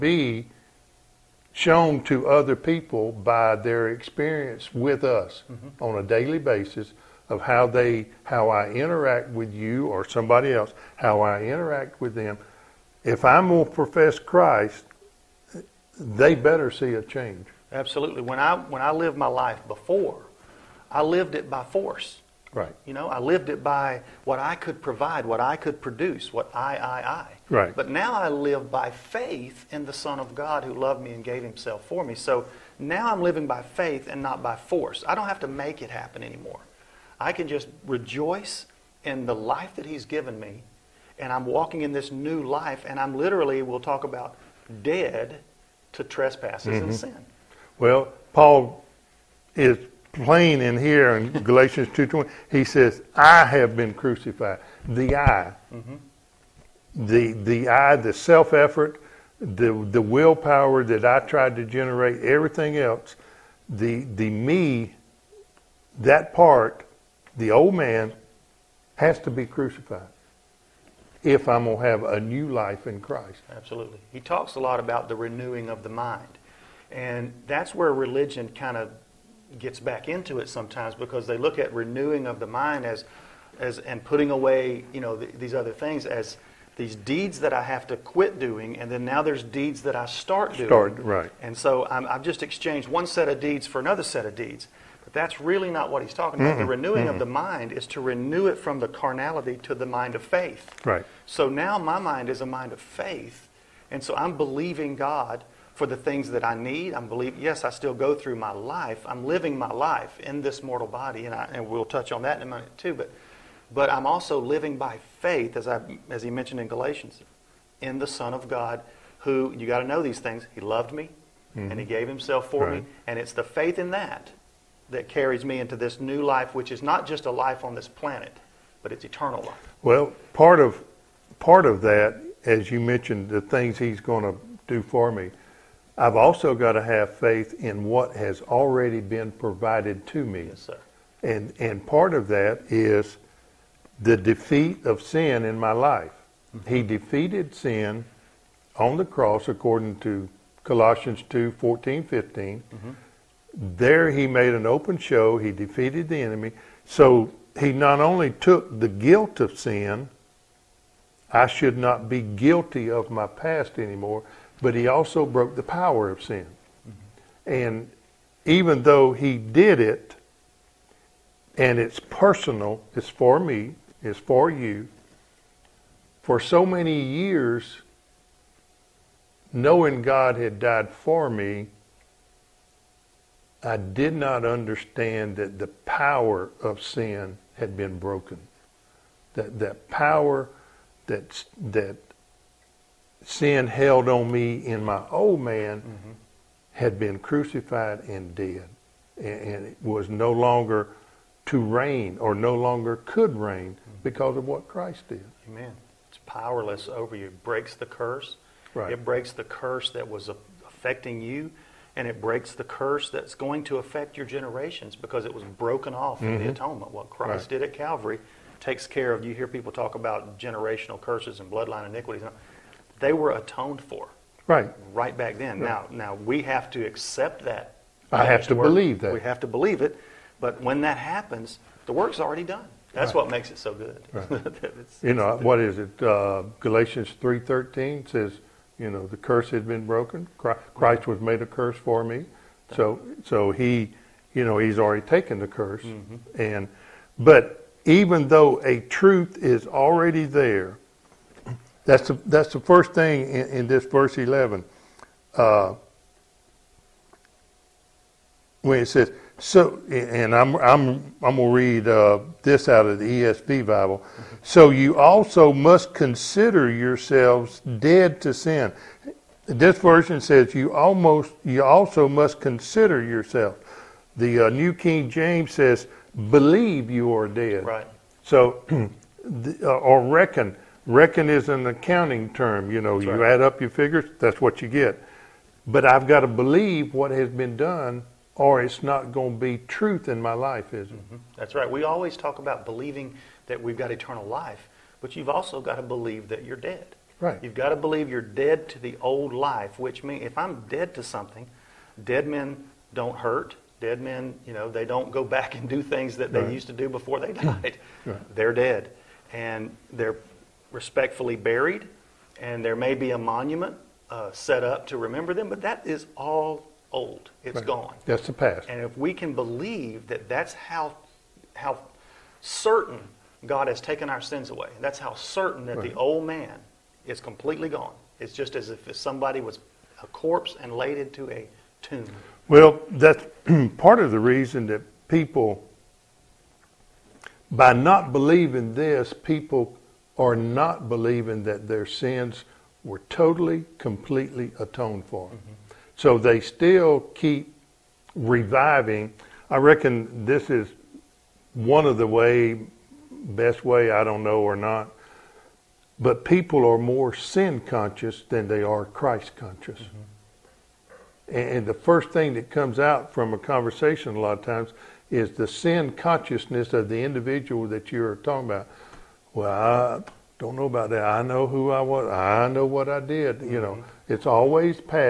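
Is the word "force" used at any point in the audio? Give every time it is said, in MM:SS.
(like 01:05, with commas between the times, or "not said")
00:21, 00:34.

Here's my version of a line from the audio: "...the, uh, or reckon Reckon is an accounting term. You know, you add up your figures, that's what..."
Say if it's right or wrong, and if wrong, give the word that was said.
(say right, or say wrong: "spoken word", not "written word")
right.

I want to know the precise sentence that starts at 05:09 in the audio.
And they're respectfully buried, and there may be a monument uh, set up to remember them, but that is all old.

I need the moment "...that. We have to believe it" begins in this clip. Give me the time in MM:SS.
03:49.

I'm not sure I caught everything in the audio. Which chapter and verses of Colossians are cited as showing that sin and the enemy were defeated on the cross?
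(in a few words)
Colossians 2:14-15.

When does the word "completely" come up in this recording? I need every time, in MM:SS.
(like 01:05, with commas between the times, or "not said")
05:27, 05:43.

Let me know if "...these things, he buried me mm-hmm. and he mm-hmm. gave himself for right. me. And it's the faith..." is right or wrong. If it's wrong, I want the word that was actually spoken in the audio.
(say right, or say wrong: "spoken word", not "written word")
wrong: "loved", not "buried".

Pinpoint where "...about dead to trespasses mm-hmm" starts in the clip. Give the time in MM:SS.
00:44.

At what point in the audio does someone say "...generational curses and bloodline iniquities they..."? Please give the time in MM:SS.
03:40.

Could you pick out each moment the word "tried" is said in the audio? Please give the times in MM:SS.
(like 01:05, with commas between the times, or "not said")
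01:01.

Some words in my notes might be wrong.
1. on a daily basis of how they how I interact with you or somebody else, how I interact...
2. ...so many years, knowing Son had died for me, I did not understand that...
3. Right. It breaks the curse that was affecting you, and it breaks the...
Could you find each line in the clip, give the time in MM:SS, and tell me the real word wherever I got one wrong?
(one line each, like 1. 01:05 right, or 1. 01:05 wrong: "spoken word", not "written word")
1. 00:05 right
2. 02:56 wrong: "God", not "Son"
3. 03:28 right.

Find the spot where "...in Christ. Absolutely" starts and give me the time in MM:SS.
01:12.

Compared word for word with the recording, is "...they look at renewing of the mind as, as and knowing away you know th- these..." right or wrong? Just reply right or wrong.
wrong.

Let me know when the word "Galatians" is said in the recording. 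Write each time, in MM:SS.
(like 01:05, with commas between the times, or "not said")
00:51, 01:56, 03:56.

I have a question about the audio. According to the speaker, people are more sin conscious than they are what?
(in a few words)
Christ conscious.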